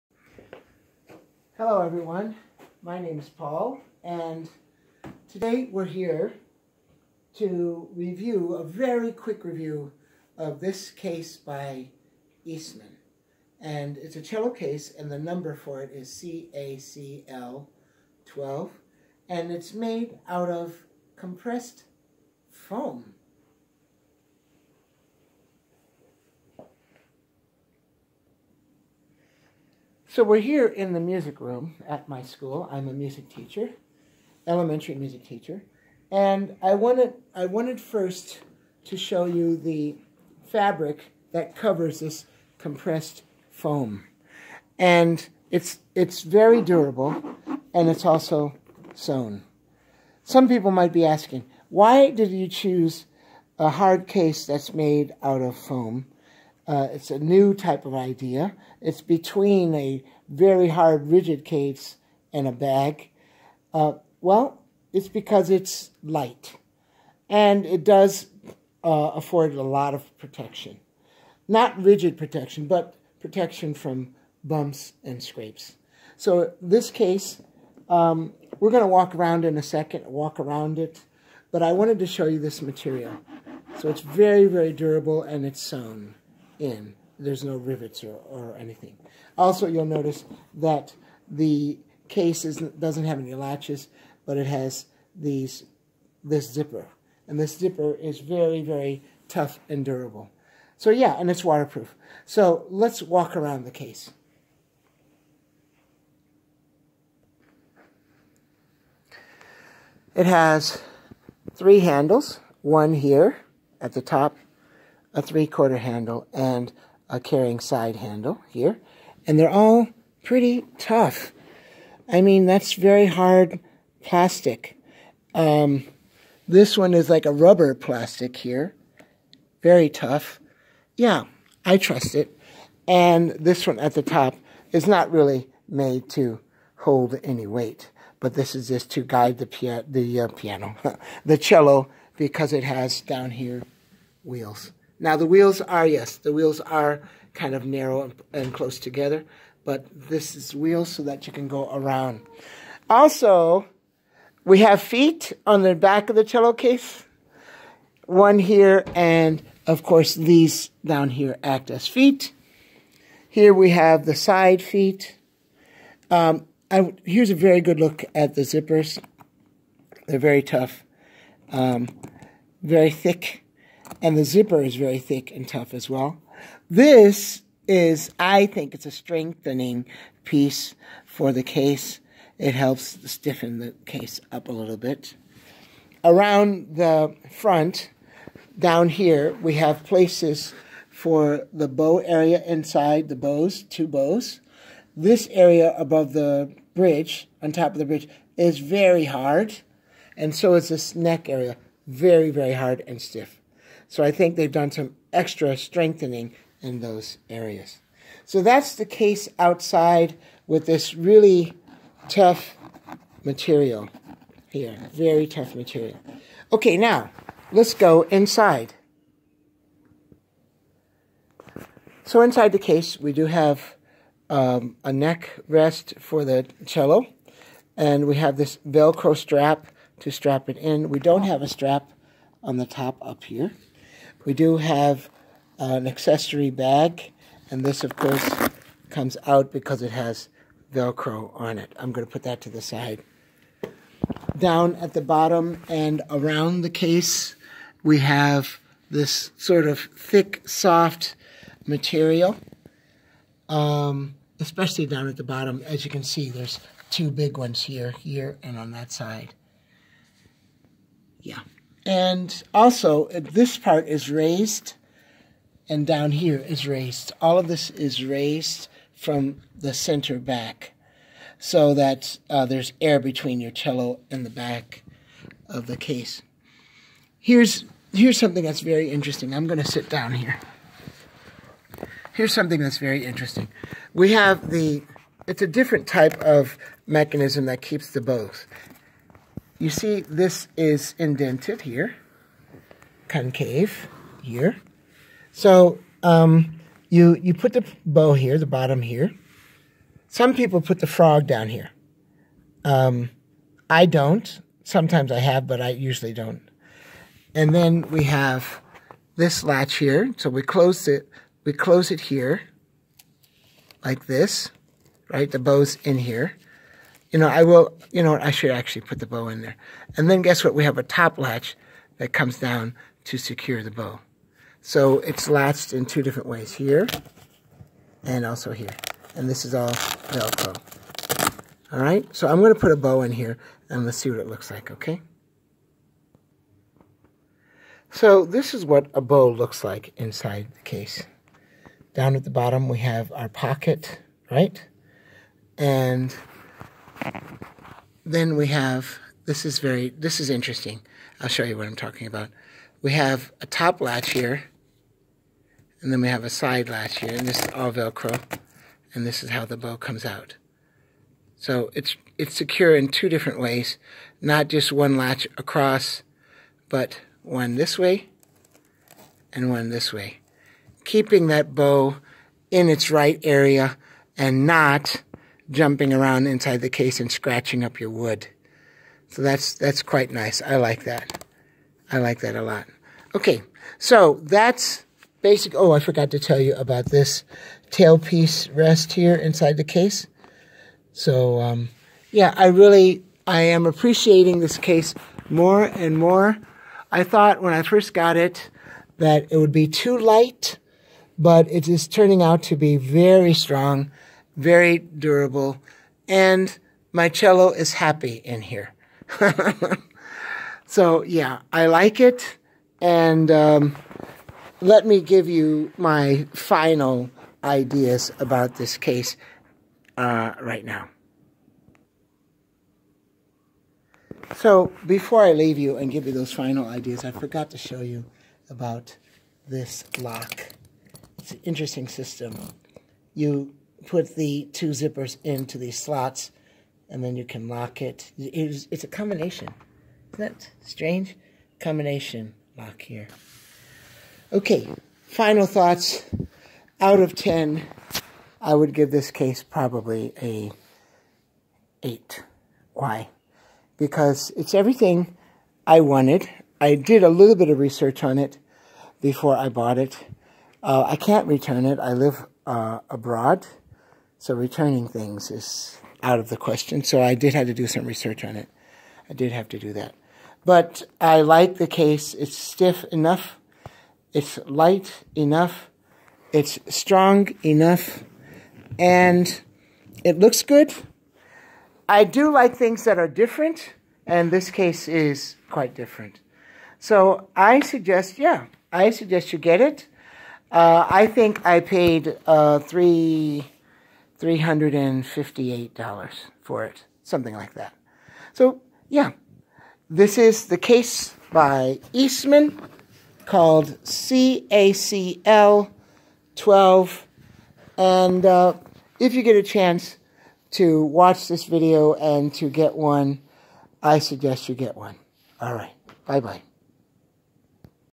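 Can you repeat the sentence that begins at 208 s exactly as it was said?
So that's the case outside with this really tough material here.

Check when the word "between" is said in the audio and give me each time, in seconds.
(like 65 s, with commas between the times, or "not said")
59 s, 272 s.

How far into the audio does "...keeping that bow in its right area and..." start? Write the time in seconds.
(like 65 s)
370 s.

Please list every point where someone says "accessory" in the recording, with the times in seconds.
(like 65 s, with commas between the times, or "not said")
235 s.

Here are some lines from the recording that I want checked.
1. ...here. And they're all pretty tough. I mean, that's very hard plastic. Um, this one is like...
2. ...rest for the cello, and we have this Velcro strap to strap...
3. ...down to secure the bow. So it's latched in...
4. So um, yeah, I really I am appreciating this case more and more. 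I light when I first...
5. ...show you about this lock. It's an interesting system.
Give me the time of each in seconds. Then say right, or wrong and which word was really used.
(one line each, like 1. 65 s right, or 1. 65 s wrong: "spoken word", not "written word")
1. 118 s right
2. 225 s right
3. 322 s right
4. 390 s wrong: "thought", not "light"
5. 427 s right.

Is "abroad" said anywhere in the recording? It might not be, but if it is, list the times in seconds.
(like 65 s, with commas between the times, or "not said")
462 s.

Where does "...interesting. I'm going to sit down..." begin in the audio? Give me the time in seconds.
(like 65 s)
278 s.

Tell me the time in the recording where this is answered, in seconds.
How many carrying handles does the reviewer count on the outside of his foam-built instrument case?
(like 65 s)
111 s.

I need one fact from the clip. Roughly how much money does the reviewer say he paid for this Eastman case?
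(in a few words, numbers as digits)
$358.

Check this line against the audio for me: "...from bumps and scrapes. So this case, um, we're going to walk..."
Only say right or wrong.
right.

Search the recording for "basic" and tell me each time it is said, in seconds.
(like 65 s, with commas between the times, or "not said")
385 s.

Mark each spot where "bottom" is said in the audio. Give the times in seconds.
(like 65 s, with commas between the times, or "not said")
245 s, 255 s, 298 s, 342 s.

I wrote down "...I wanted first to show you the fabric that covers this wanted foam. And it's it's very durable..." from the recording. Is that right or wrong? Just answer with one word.
wrong.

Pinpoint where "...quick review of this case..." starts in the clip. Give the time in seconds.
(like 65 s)
9 s.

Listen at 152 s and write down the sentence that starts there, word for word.
Also, we have feet on the back of the cello case, one here, and of course these down here act as feet.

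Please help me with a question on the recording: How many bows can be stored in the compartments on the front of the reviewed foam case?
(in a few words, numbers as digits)
2.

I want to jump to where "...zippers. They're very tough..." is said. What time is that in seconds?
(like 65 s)
168 s.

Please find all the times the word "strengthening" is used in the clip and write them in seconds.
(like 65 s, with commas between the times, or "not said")
178 s, 205 s.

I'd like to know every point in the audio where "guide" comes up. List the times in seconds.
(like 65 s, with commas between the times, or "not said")
139 s.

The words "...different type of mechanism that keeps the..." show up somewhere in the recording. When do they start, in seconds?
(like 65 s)
285 s.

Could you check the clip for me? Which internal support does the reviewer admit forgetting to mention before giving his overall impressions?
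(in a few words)
tailpiece rest.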